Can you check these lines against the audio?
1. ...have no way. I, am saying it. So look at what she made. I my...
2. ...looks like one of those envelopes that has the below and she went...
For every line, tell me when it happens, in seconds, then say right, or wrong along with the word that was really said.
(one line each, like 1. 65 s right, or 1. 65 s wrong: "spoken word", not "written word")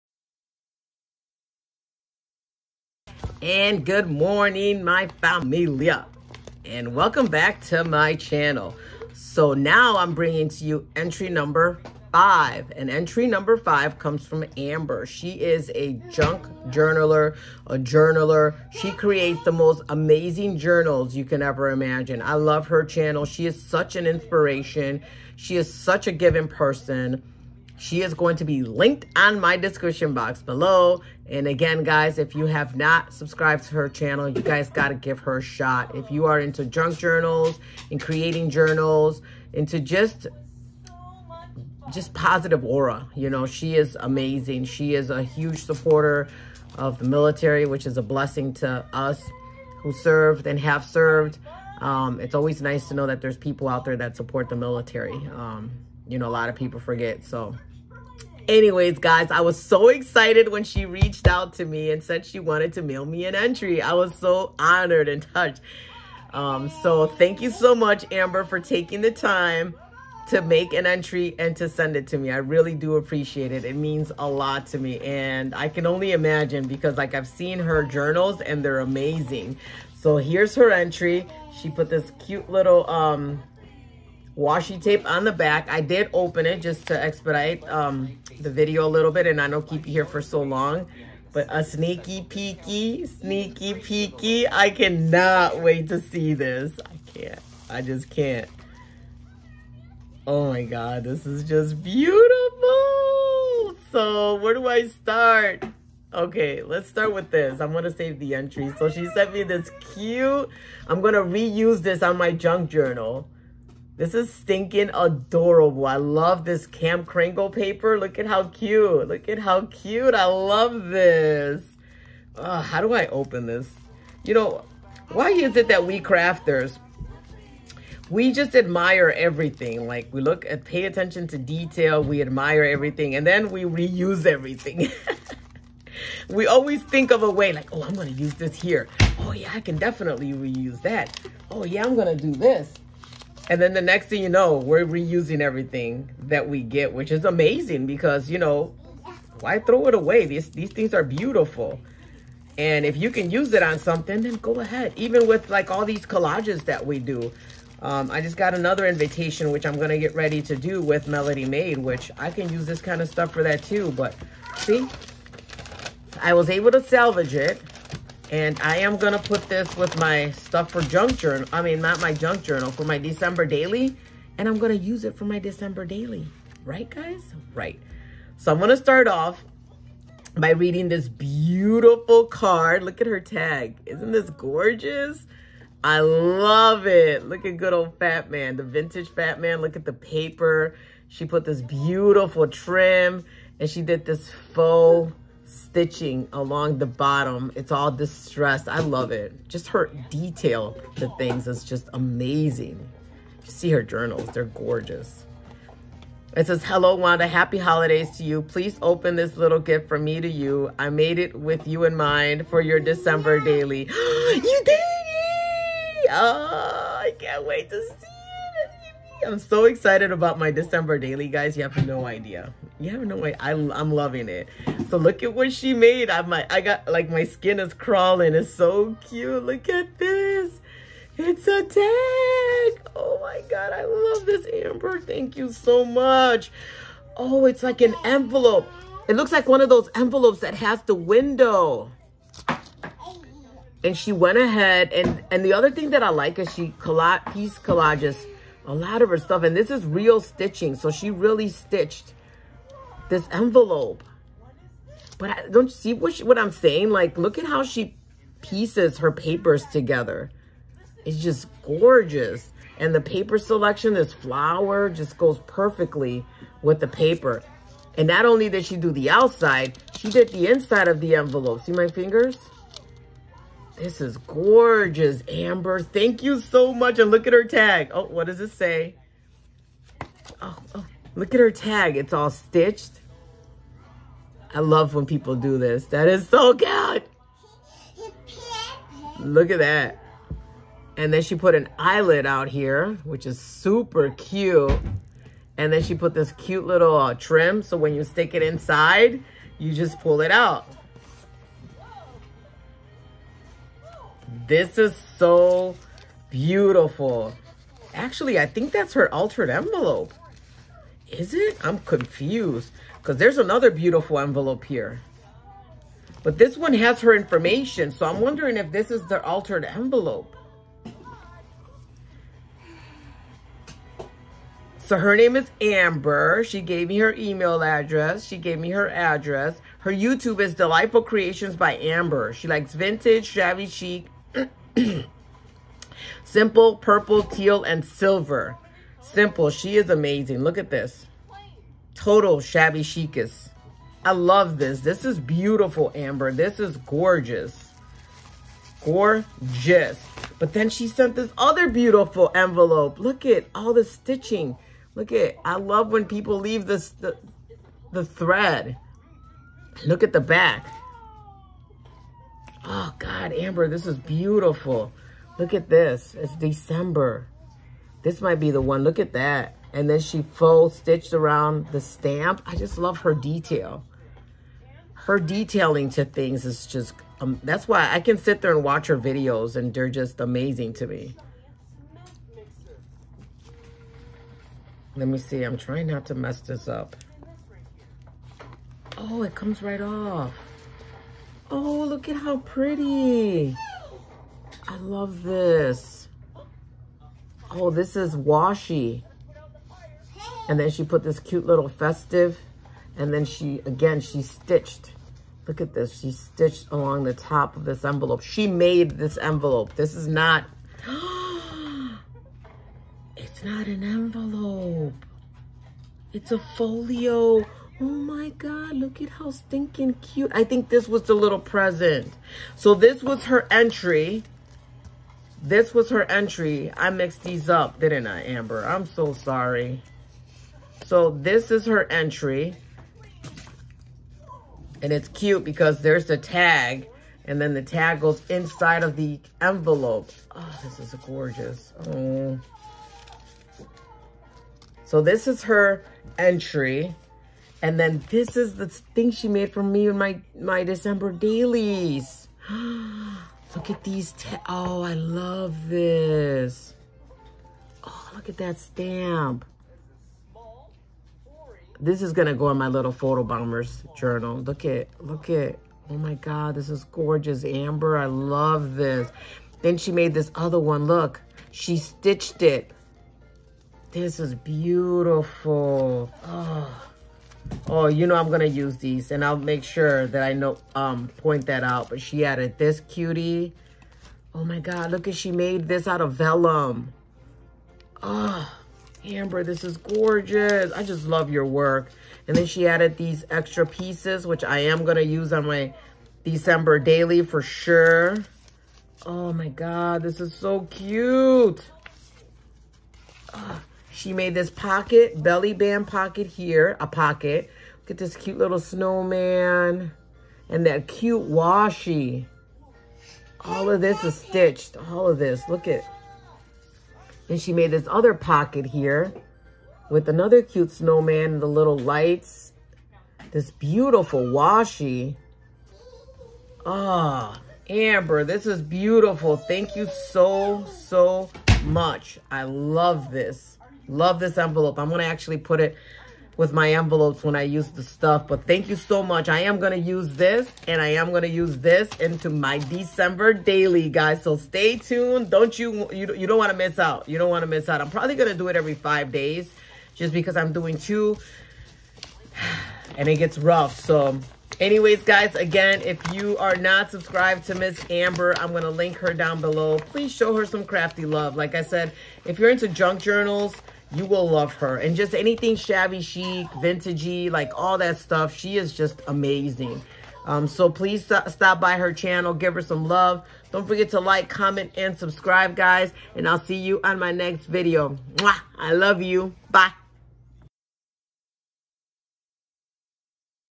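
1. 222 s wrong: "loving", not "saying"
2. 239 s wrong: "window", not "below".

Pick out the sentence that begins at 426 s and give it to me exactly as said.
I mixed these up, didn't I, Amber?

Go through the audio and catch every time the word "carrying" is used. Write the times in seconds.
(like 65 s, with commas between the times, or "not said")
not said.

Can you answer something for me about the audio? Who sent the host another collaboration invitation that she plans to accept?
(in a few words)
Melody Made.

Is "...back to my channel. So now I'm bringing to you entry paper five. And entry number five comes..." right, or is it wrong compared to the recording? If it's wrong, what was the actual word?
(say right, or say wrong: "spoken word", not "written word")
wrong: "number", not "paper".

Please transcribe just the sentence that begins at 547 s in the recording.
I'm probably going to do it every five days just because I'm doing two and it gets rough.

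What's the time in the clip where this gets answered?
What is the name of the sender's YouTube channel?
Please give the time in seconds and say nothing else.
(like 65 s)
330 s.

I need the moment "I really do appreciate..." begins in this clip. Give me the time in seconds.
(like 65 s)
72 s.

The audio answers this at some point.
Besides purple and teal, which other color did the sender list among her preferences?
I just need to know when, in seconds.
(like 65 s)
337 s.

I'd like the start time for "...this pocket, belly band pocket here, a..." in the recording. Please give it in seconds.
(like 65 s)
504 s.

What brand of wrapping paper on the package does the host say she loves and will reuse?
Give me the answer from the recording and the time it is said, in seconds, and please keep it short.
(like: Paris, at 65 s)
Cam Kringle, at 116 s.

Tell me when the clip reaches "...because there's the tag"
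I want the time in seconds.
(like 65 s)
435 s.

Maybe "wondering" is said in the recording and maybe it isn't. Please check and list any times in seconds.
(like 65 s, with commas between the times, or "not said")
318 s.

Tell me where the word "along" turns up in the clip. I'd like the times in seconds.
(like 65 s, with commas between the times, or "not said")
196 s, 406 s.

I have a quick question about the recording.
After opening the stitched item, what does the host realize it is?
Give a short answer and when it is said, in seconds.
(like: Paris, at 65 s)
a folio, at 416 s.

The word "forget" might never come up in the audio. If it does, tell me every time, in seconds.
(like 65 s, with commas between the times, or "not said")
56 s, 573 s.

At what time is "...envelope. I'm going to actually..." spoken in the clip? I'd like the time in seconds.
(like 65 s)
534 s.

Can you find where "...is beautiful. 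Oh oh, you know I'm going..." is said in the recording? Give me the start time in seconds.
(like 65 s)
474 s.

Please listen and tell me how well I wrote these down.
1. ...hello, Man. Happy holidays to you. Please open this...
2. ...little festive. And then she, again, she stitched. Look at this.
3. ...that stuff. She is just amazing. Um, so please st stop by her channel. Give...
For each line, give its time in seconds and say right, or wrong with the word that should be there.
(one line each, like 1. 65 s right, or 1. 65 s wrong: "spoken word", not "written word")
1. 206 s wrong: "Wanda", not "Man"
2. 401 s right
3. 567 s right.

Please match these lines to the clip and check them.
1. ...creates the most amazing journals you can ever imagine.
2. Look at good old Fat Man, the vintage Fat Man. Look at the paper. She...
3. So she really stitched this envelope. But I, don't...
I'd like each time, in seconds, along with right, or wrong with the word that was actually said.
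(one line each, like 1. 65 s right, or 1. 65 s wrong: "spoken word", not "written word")
1. 18 s right
2. 187 s right
3. 250 s right.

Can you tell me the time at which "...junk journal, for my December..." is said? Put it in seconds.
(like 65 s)
172 s.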